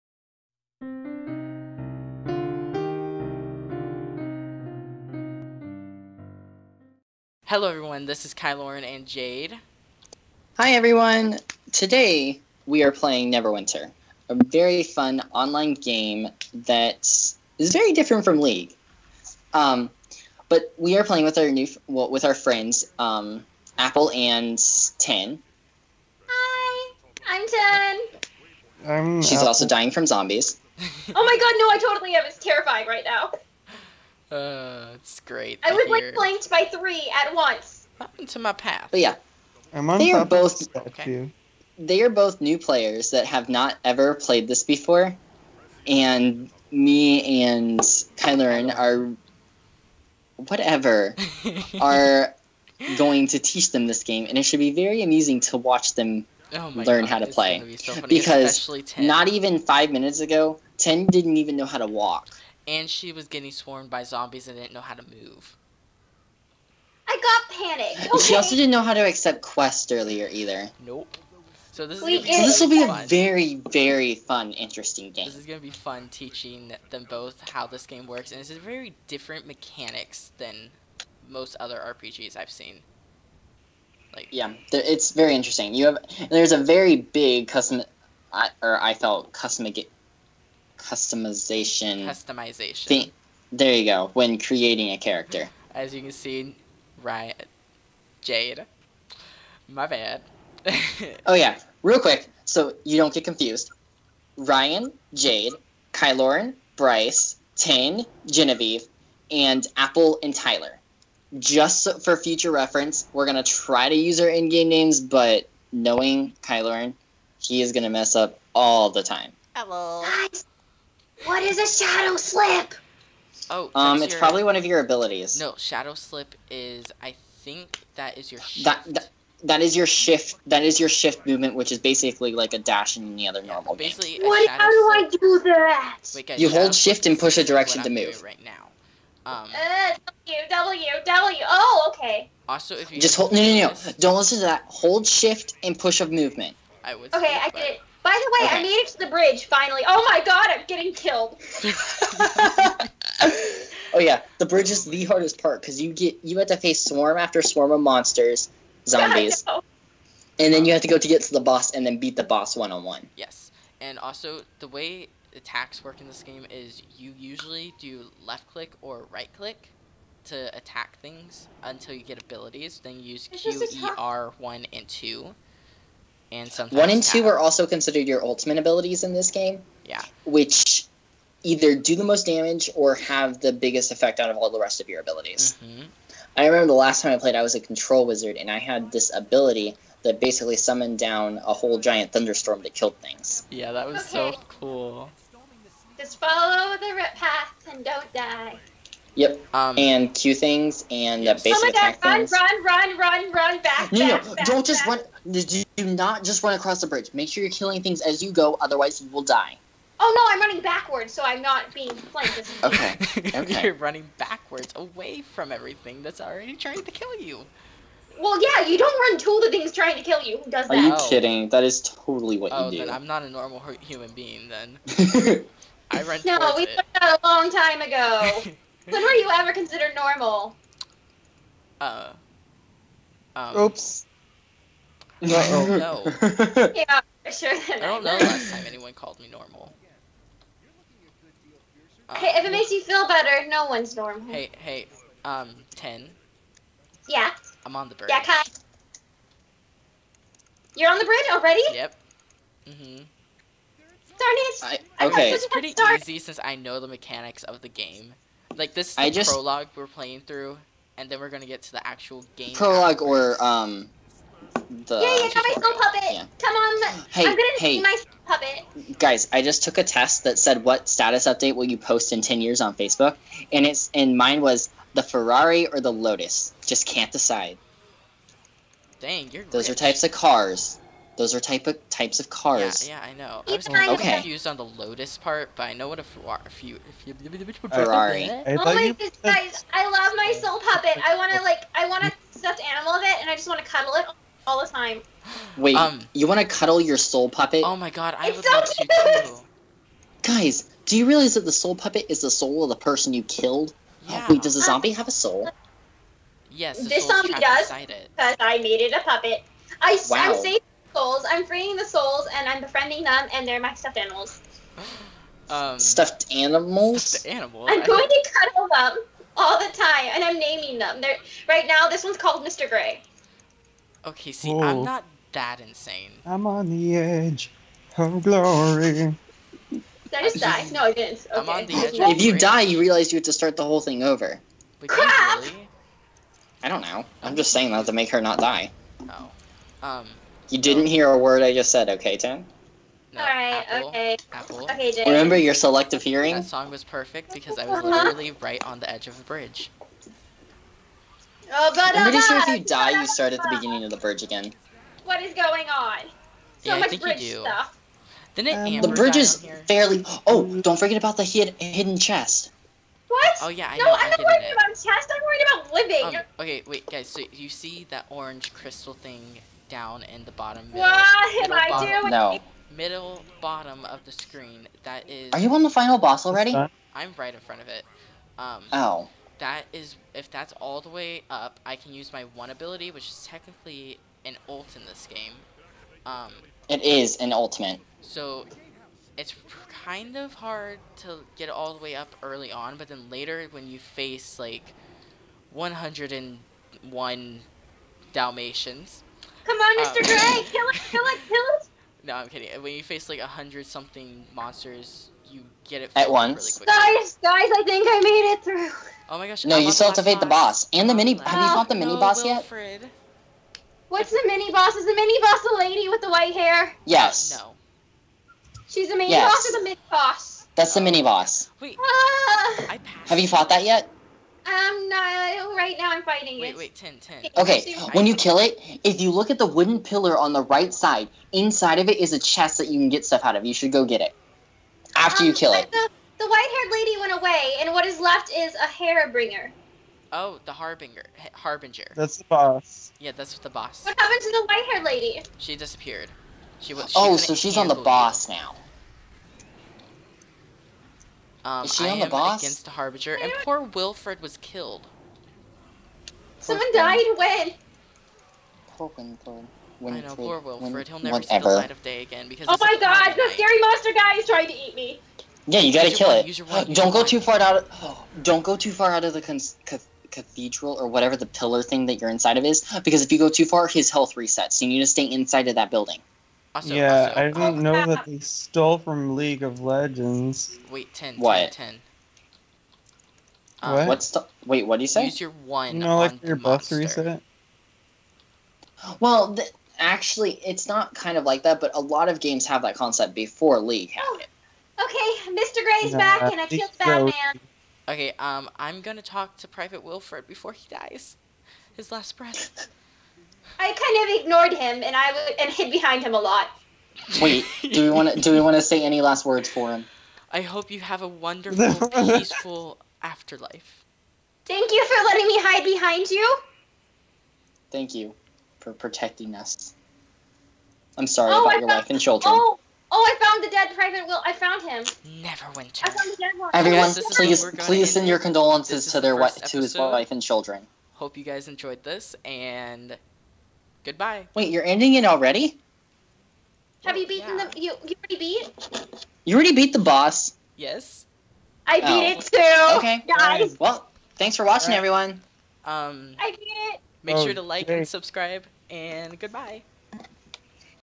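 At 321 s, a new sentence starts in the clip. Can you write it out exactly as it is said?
They're, right now, this one's called Mr.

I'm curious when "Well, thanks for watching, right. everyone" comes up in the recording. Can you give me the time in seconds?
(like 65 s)
543 s.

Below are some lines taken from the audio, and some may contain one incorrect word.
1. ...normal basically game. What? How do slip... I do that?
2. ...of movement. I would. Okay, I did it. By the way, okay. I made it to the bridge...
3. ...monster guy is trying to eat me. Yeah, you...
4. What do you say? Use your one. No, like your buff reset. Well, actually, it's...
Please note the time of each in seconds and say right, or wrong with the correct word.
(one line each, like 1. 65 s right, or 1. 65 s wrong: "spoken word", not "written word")
1. 133 s right
2. 146 s right
3. 463 s right
4. 484 s right.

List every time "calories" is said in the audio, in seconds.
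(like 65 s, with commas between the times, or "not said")
not said.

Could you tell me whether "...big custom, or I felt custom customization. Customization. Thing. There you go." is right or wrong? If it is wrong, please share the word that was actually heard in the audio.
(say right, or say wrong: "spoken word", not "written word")
right.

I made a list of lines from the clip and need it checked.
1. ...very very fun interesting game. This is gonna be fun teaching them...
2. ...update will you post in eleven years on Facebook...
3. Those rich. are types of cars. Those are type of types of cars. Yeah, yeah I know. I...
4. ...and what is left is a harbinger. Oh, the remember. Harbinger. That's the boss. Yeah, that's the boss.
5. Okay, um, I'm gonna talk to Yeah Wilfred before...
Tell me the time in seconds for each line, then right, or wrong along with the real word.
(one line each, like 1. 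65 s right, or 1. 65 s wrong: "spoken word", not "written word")
1. 73 s right
2. 271 s wrong: "ten", not "eleven"
3. 279 s right
4. 437 s wrong: "harbinger", not "remember"
5. 497 s wrong: "Private", not "Yeah".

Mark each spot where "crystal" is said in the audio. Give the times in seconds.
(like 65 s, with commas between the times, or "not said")
368 s.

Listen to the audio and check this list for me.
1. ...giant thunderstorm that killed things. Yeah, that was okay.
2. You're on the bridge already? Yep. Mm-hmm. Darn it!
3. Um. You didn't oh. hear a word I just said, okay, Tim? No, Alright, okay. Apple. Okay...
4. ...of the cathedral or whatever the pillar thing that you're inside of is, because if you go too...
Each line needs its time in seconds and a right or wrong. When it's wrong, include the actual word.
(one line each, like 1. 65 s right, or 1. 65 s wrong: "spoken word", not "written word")
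1. 191 s right
2. 250 s right
3. 339 s right
4. 469 s right.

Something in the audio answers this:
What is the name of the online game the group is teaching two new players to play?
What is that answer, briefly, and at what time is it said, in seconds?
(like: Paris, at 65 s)
Neverwinter, at 13 s.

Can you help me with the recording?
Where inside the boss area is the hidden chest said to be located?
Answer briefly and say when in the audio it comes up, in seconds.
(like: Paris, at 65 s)
Wooden pillar, at 429 s.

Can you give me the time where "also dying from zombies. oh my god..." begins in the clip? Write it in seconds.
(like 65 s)
29 s.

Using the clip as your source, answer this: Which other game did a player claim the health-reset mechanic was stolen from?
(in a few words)
League of Legends.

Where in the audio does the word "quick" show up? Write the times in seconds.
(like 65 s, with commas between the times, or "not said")
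101 s.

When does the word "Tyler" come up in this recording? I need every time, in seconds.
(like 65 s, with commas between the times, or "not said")
110 s.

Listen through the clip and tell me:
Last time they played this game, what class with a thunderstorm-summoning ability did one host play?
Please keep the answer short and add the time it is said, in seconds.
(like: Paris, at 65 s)
Control wizard, at 187 s.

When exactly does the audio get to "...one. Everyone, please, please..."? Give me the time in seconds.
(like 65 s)
526 s.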